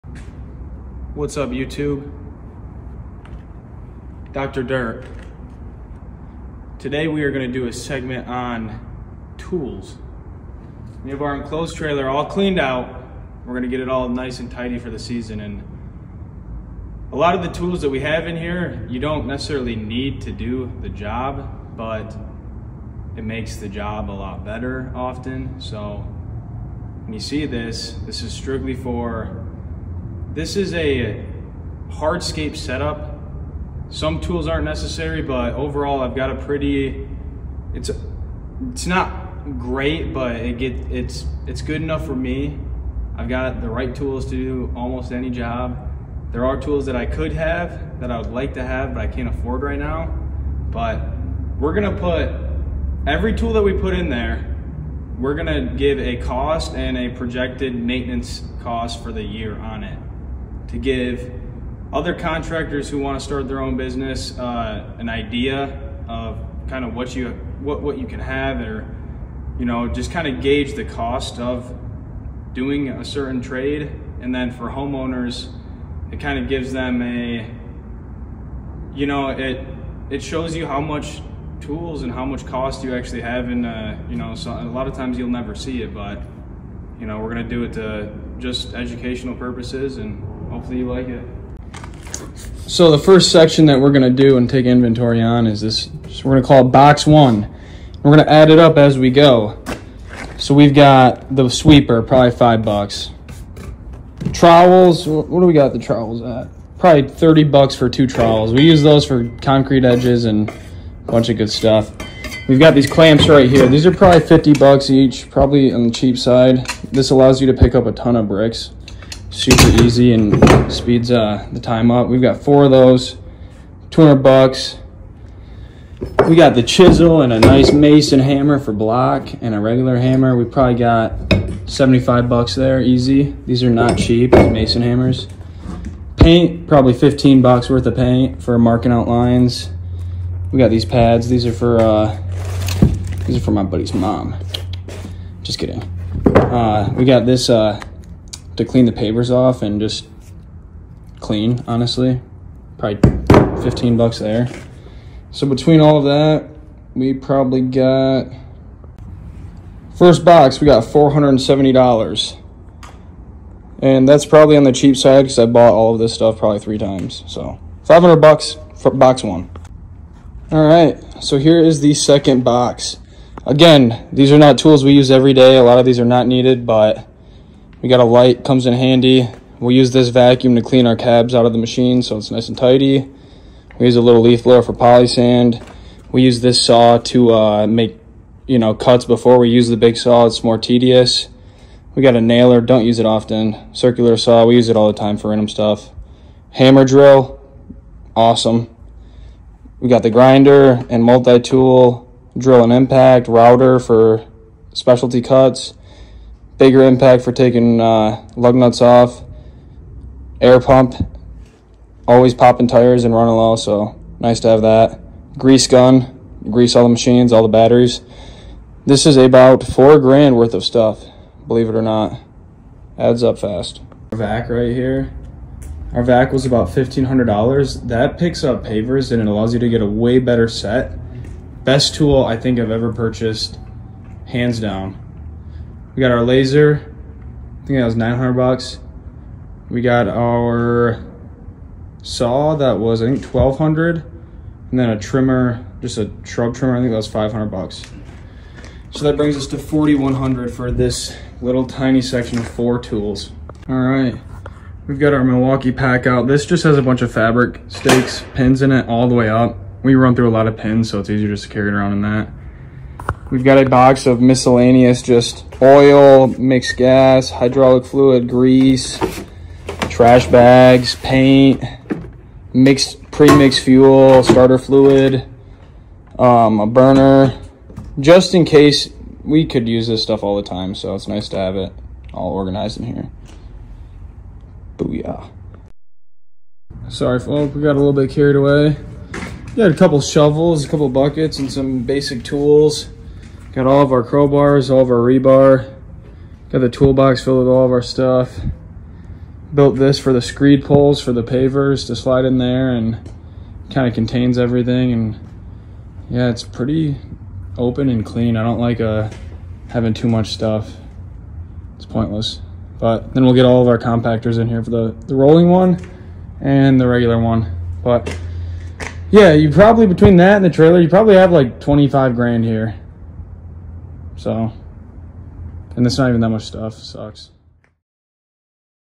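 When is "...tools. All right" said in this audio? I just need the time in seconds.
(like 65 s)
252 s.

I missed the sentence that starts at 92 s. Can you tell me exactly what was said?
So the first section that we're going to do and take inventory on is this.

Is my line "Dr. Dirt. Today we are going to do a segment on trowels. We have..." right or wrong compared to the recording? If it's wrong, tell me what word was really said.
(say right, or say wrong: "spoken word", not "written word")
wrong: "tools", not "trowels".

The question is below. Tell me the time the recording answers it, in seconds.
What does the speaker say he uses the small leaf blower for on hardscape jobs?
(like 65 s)
184 s.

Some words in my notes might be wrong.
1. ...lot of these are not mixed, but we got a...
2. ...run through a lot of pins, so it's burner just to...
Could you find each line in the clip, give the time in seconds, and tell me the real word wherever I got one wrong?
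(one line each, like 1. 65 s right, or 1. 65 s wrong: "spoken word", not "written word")
1. 175 s wrong: "needed", not "mixed"
2. 259 s wrong: "easier", not "burner".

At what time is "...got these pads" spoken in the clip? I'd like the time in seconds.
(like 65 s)
140 s.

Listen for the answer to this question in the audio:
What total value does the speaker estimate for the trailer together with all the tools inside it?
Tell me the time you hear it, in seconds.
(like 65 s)
321 s.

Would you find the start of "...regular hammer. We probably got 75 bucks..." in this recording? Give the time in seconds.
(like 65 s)
129 s.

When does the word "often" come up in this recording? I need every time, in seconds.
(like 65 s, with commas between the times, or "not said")
24 s, 193 s.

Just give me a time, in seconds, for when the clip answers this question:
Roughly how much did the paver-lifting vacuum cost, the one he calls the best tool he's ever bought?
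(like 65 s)
226 s.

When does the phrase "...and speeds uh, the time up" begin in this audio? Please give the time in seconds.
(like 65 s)
120 s.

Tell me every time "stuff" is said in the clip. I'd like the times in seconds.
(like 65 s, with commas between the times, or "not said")
111 s, 166 s, 195 s, 220 s, 280 s, 297 s, 310 s, 326 s.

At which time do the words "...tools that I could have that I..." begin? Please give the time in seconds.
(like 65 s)
46 s.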